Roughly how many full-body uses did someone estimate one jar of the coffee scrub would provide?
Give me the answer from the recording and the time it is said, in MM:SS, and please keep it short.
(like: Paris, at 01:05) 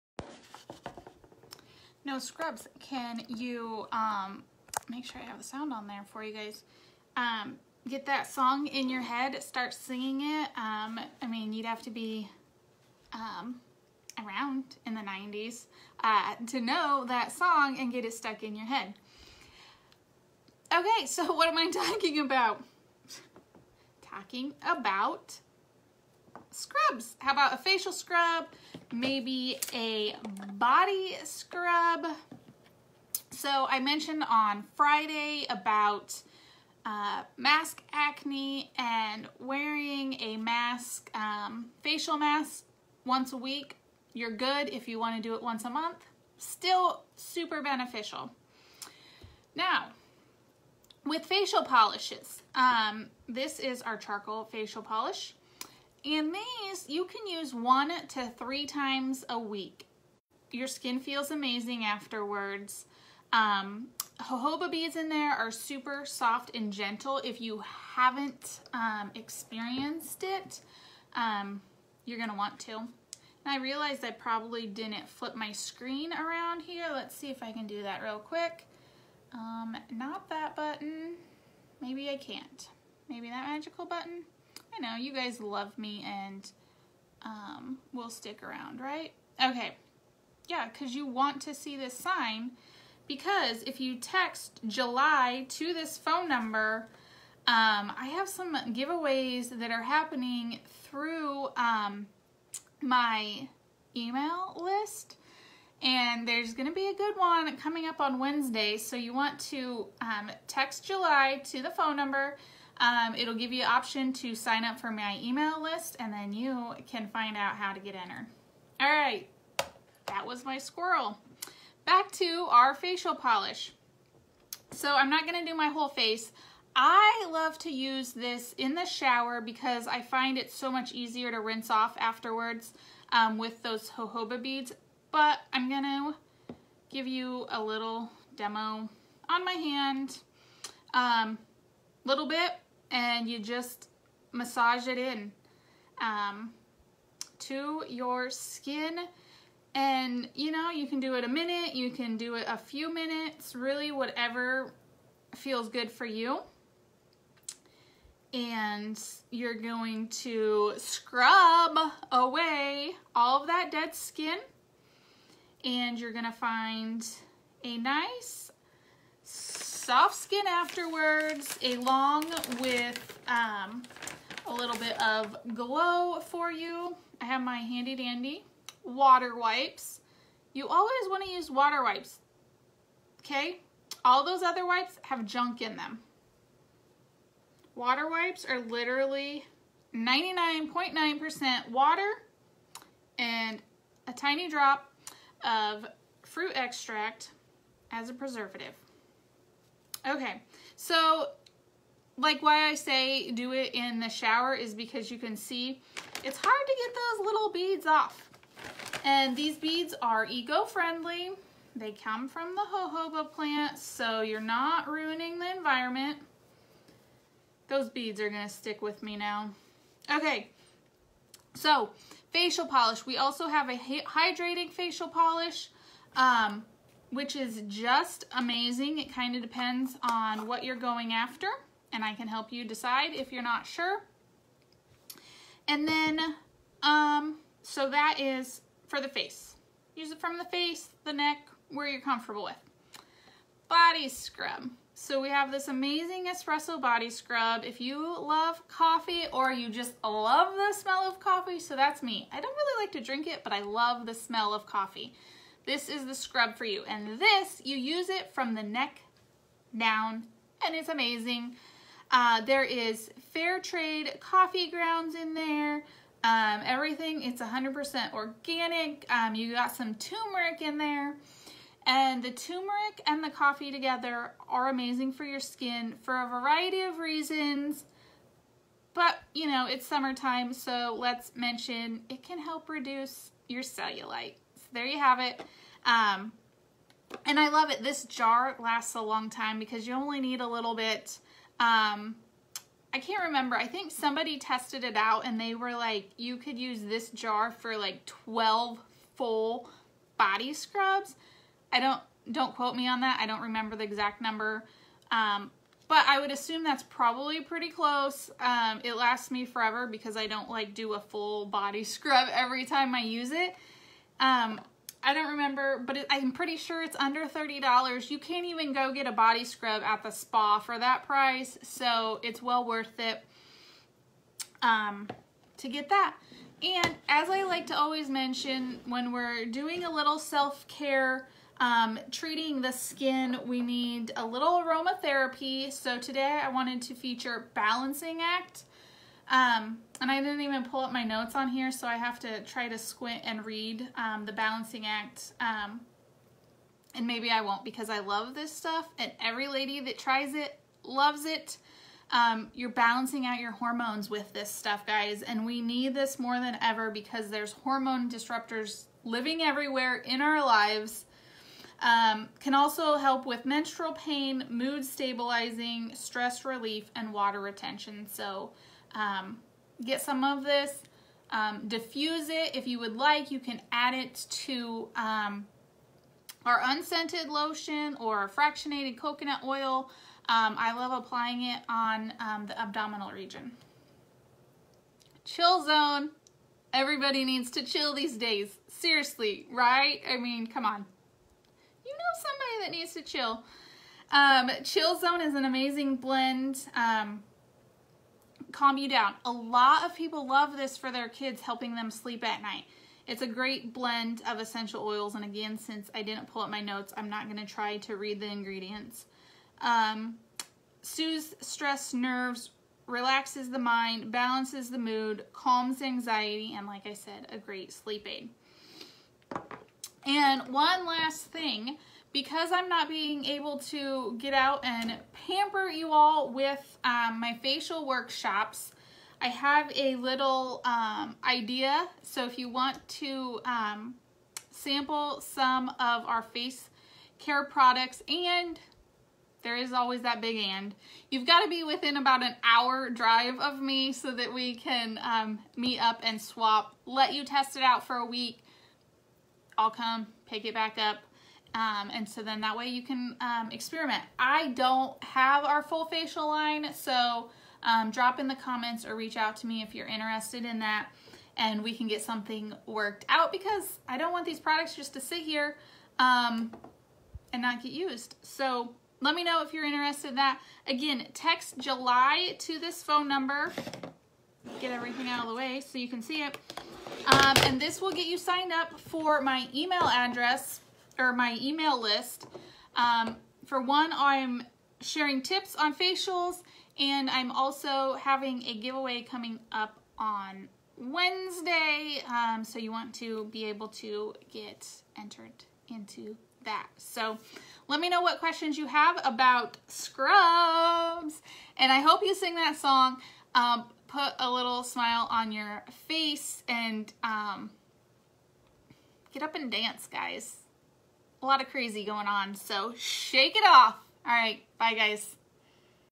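12, at 04:58.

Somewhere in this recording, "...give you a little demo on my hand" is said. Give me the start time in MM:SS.
02:16.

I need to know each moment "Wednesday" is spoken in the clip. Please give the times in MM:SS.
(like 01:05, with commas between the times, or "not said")
01:48, 08:10.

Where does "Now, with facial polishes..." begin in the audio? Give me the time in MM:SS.
00:49.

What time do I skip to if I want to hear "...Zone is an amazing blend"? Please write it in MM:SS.
06:34.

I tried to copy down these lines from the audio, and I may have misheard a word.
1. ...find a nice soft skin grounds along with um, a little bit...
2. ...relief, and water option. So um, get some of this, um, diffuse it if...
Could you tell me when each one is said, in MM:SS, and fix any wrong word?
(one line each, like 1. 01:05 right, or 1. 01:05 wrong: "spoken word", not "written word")
1. 02:46 wrong: "afterwards", not "grounds"
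2. 06:06 wrong: "retention", not "option".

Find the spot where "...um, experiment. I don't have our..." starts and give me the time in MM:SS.
07:33.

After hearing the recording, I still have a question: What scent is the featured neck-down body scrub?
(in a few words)
Espresso.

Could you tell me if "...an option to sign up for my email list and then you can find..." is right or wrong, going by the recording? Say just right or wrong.
right.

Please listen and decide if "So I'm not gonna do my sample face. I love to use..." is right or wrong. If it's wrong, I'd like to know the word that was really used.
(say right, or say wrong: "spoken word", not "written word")
wrong: "whole", not "sample".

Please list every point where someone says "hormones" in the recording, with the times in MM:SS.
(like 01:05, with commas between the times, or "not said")
05:53, 05:57.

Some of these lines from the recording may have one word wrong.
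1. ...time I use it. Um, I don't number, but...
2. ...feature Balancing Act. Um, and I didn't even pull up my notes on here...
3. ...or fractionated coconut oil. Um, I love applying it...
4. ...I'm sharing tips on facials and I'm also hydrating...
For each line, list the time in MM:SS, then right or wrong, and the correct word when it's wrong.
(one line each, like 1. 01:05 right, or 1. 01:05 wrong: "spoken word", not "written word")
1. 05:12 wrong: "remember", not "number"
2. 05:36 right
3. 06:17 right
4. 08:03 wrong: "having", not "hydrating".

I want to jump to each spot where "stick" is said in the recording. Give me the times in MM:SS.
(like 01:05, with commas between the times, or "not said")
01:28, 03:38.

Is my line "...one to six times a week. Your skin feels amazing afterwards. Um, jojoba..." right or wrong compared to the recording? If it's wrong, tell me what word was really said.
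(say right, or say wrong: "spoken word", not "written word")
wrong: "three", not "six".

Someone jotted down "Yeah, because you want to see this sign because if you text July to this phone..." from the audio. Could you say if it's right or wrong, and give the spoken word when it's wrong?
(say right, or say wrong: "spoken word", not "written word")
right.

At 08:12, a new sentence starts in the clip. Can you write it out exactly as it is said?
Um, so you want to be able to get entered into that.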